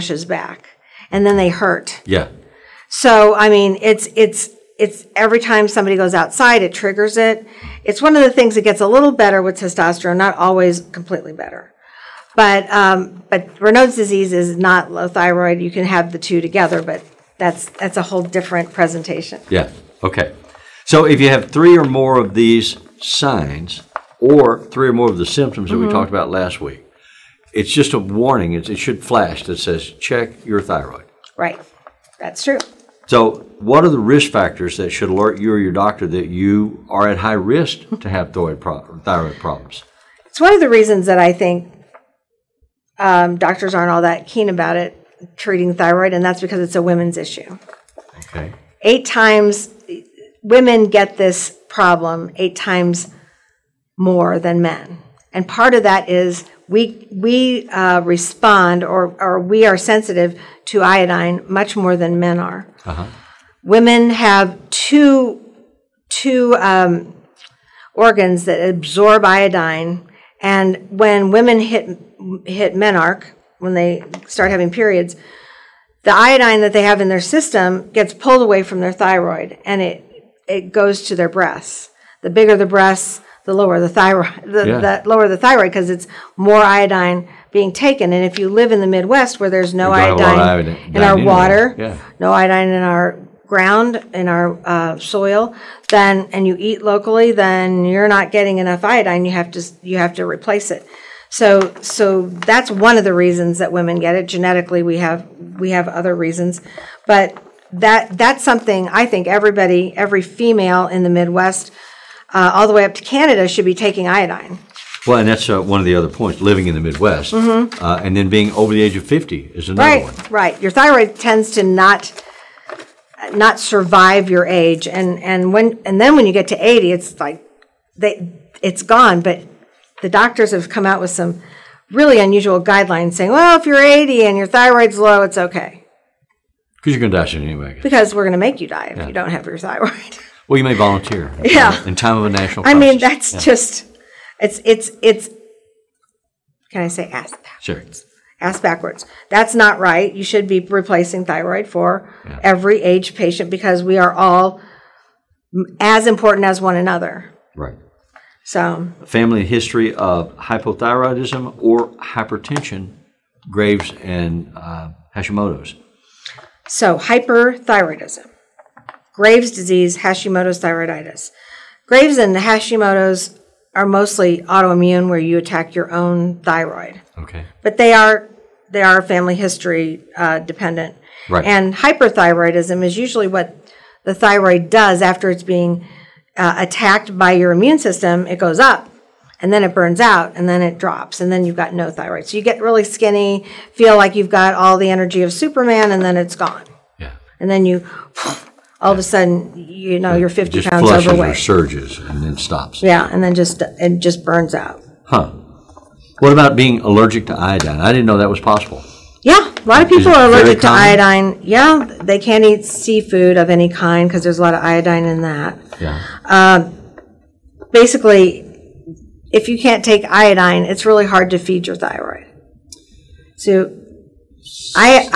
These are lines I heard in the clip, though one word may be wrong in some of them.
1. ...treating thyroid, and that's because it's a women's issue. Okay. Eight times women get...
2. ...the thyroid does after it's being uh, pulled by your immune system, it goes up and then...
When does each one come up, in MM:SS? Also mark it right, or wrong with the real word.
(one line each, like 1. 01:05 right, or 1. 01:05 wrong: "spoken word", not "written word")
1. 00:45 right
2. 03:04 wrong: "attacked", not "pulled".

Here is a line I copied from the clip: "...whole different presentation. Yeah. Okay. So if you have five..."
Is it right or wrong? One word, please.
wrong.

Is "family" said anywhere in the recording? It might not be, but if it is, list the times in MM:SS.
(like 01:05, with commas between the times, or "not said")
02:39, 02:58.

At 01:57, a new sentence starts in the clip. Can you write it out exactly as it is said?
uh, and then being over the age of fifty is another right, one.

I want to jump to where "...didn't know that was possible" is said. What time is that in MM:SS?
03:27.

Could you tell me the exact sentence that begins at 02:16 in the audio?
Because you're going to die soon anyway.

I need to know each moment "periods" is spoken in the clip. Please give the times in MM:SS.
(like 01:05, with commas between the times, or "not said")
01:14.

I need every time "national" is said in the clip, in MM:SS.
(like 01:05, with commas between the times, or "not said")
02:22.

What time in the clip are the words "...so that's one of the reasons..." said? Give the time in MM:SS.
01:41.